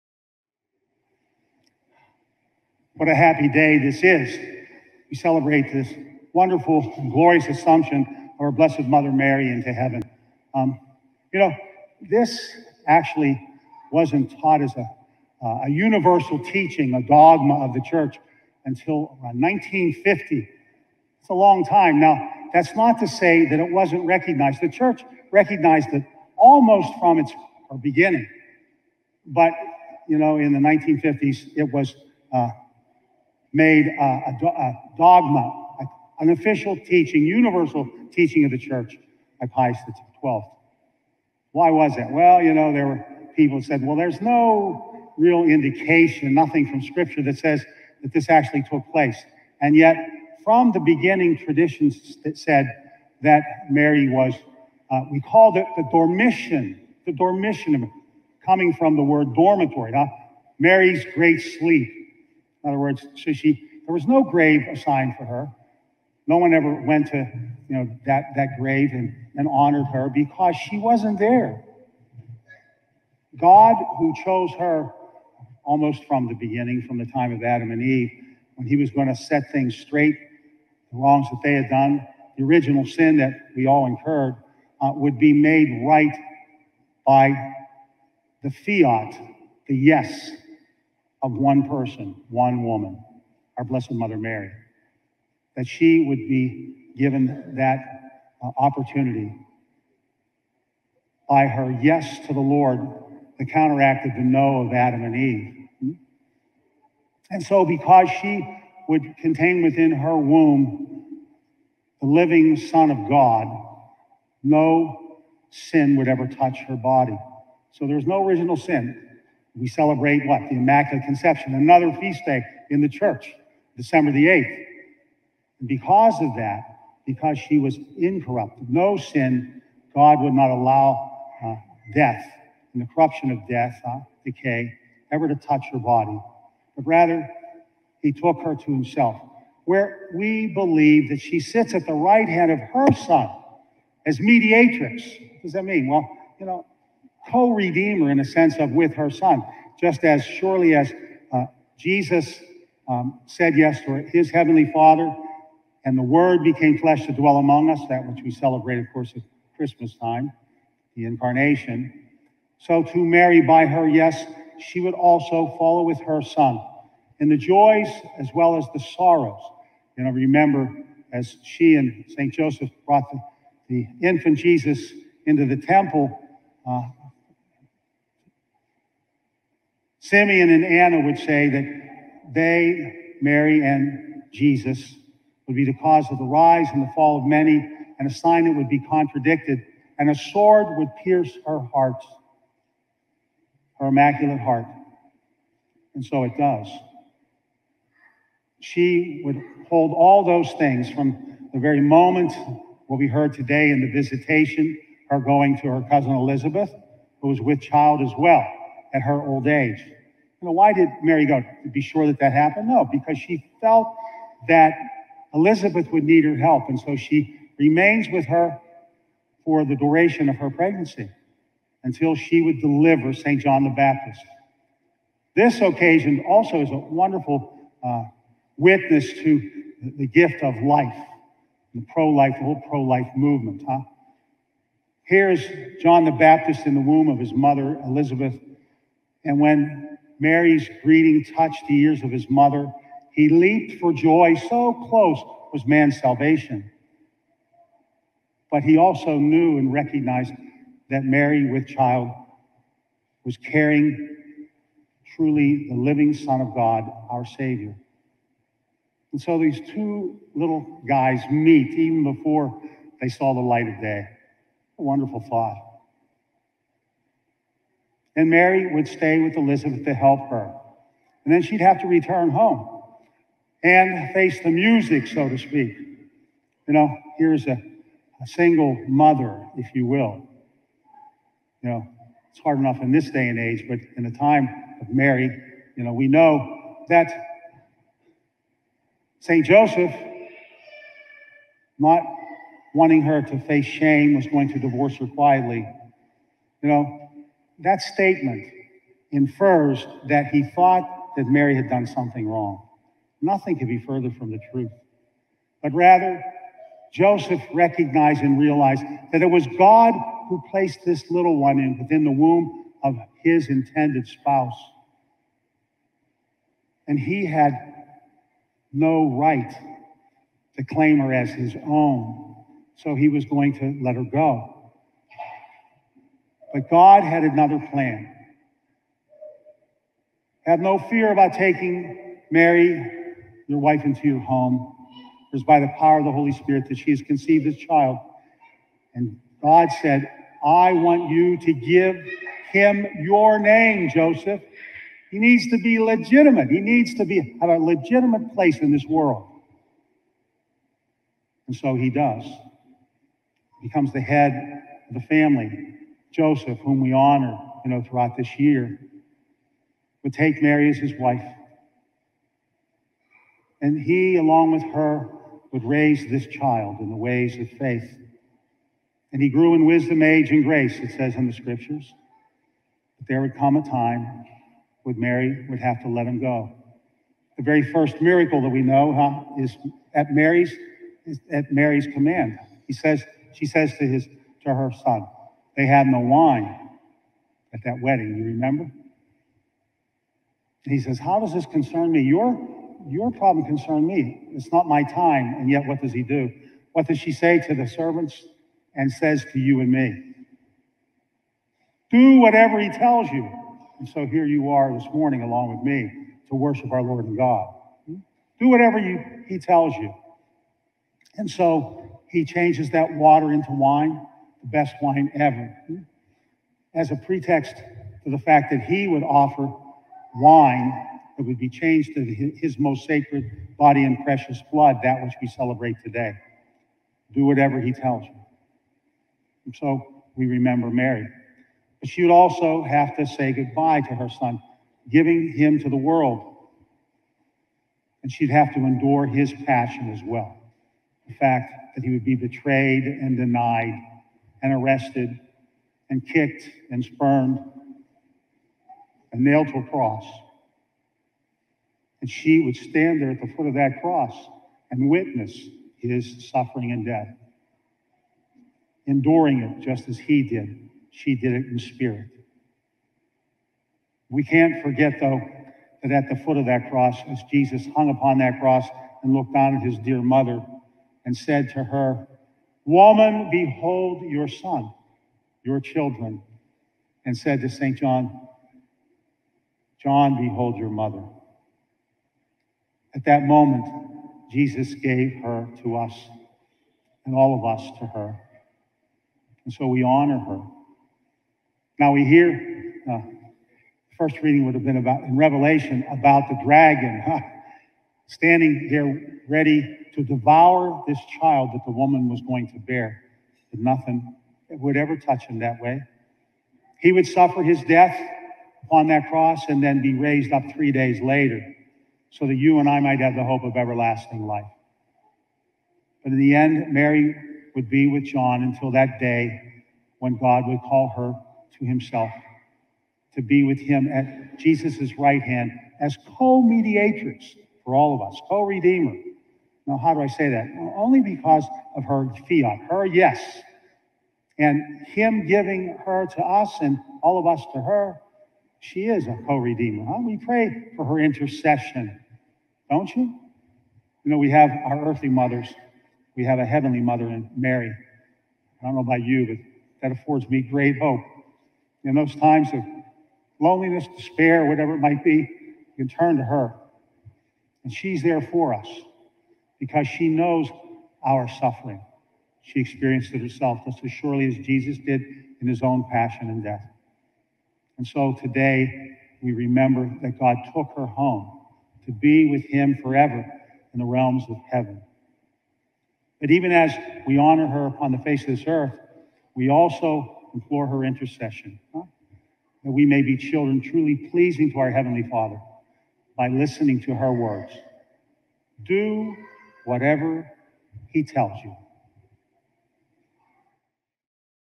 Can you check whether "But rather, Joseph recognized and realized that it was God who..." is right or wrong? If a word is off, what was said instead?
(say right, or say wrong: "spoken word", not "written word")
right.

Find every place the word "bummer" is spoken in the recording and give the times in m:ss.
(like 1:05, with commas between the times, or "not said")
not said.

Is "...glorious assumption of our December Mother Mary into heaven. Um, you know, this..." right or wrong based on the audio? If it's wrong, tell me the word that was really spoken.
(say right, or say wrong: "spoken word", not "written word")
wrong: "Blessed", not "December".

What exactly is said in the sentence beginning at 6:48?
Do whatever you, he tells you.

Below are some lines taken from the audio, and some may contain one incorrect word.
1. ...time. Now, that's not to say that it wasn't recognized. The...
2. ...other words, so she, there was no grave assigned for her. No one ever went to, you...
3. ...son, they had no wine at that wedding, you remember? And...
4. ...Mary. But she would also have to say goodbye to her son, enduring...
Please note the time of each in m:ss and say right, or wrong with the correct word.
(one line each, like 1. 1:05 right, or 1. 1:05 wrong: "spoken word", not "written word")
1. 0:21 right
2. 1:02 right
3. 6:24 right
4. 7:10 wrong: "giving", not "enduring".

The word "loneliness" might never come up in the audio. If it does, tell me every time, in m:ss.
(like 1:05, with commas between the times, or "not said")
9:13.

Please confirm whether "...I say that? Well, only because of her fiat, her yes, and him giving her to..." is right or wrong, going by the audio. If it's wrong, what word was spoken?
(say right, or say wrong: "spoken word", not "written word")
right.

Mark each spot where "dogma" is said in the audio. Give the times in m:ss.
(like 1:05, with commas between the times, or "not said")
0:17, 0:34.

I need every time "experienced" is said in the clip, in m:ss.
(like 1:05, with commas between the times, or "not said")
9:22.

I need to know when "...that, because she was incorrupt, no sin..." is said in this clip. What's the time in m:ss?
2:06.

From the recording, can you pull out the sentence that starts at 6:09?
And he grew in wisdom, age, and grace, it says in the scriptures.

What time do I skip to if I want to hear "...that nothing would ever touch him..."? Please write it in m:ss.
8:23.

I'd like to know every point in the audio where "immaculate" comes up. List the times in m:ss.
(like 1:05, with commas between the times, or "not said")
2:00, 3:13.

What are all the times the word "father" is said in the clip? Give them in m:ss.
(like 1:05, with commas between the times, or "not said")
2:34, 9:45.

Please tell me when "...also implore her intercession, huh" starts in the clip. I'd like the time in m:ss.
9:39.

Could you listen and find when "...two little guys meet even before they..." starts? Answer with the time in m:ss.
4:19.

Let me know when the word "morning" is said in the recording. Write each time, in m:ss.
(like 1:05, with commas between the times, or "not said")
6:44.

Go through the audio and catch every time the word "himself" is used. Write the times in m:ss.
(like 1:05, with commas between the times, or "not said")
2:18, 8:41.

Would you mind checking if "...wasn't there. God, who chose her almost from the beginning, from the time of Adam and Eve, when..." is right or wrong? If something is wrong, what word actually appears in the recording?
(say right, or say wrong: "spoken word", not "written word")
right.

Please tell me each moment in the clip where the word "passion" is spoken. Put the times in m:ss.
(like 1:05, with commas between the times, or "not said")
7:19, 9:25.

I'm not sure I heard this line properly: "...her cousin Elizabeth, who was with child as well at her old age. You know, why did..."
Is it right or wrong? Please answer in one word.
right.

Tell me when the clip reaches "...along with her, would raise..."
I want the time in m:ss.
6:04.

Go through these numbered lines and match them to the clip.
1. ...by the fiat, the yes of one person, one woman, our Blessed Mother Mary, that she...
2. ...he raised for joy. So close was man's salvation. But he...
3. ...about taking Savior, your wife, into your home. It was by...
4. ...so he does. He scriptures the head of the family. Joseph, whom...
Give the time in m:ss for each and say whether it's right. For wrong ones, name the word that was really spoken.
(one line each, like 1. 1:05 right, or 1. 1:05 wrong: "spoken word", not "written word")
1. 1:27 right
2. 4:03 wrong: "leaped", not "raised"
3. 5:31 wrong: "Mary", not "Savior"
4. 5:51 wrong: "becomes", not "scriptures".